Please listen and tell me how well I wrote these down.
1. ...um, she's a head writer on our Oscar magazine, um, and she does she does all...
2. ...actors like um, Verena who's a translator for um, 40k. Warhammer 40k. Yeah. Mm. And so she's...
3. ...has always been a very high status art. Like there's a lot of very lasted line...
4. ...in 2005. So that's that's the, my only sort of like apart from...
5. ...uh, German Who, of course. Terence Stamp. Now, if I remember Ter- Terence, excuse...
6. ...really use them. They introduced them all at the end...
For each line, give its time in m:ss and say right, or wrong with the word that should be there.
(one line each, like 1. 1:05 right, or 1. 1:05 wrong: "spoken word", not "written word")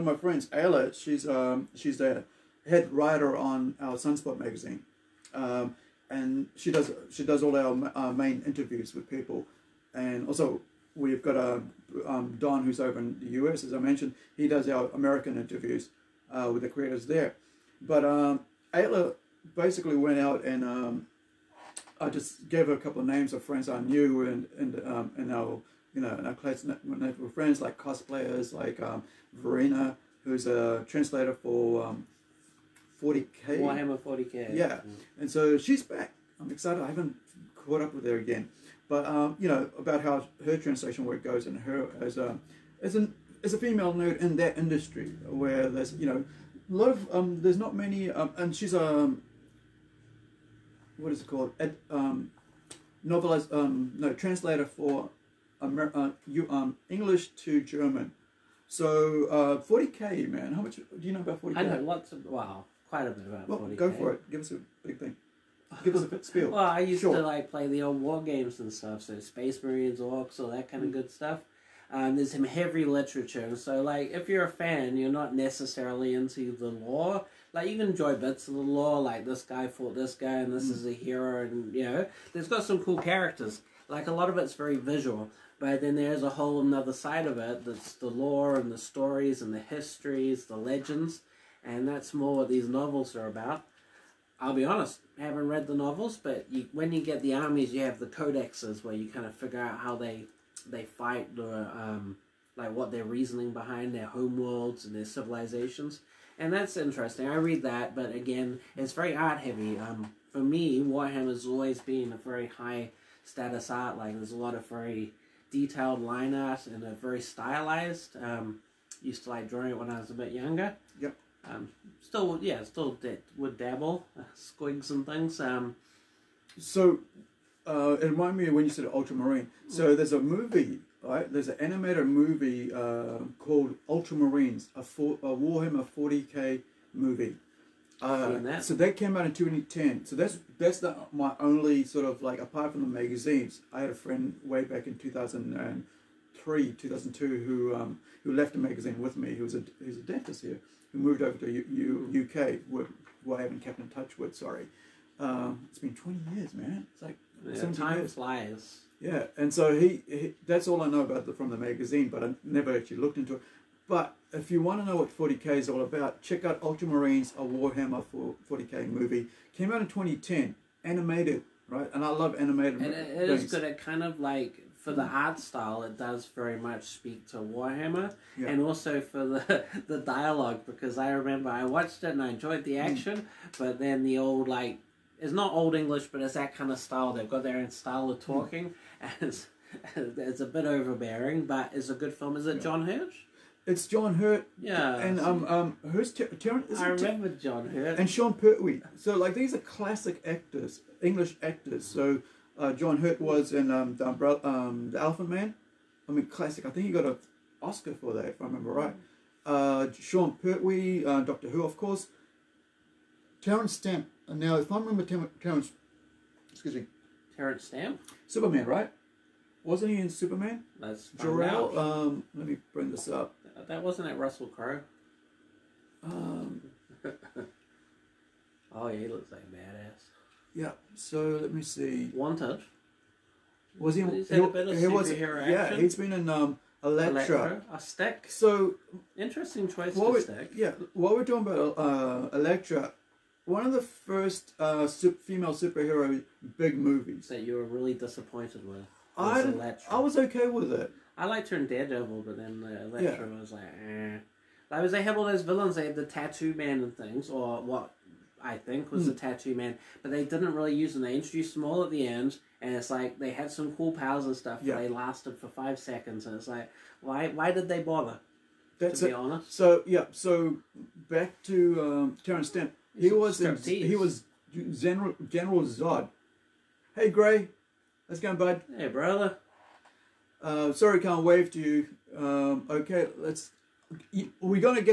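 1. 0:01 wrong: "Sunspot", not "Oscar"
2. 0:27 wrong: "cosplayers", not "actors"
3. 1:51 wrong: "detailed", not "lasted"
4. 2:19 wrong: "2010", not "2005"
5. 3:31 wrong: "Doctor", not "German"
6. 4:20 right.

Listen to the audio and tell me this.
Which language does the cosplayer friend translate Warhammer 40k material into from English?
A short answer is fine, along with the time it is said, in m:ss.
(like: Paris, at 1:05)
German, at 0:56.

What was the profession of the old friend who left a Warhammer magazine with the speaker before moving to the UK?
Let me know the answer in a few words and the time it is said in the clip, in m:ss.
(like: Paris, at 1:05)
Dentist, at 2:30.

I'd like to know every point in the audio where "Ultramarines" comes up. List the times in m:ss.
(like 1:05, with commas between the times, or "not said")
2:08, 2:13, 2:46.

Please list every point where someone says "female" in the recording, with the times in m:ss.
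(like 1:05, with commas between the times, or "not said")
0:43, 4:04.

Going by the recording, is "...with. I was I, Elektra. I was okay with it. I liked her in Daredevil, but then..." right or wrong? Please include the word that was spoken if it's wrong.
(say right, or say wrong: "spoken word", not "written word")
right.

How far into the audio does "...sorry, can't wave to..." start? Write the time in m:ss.
4:40.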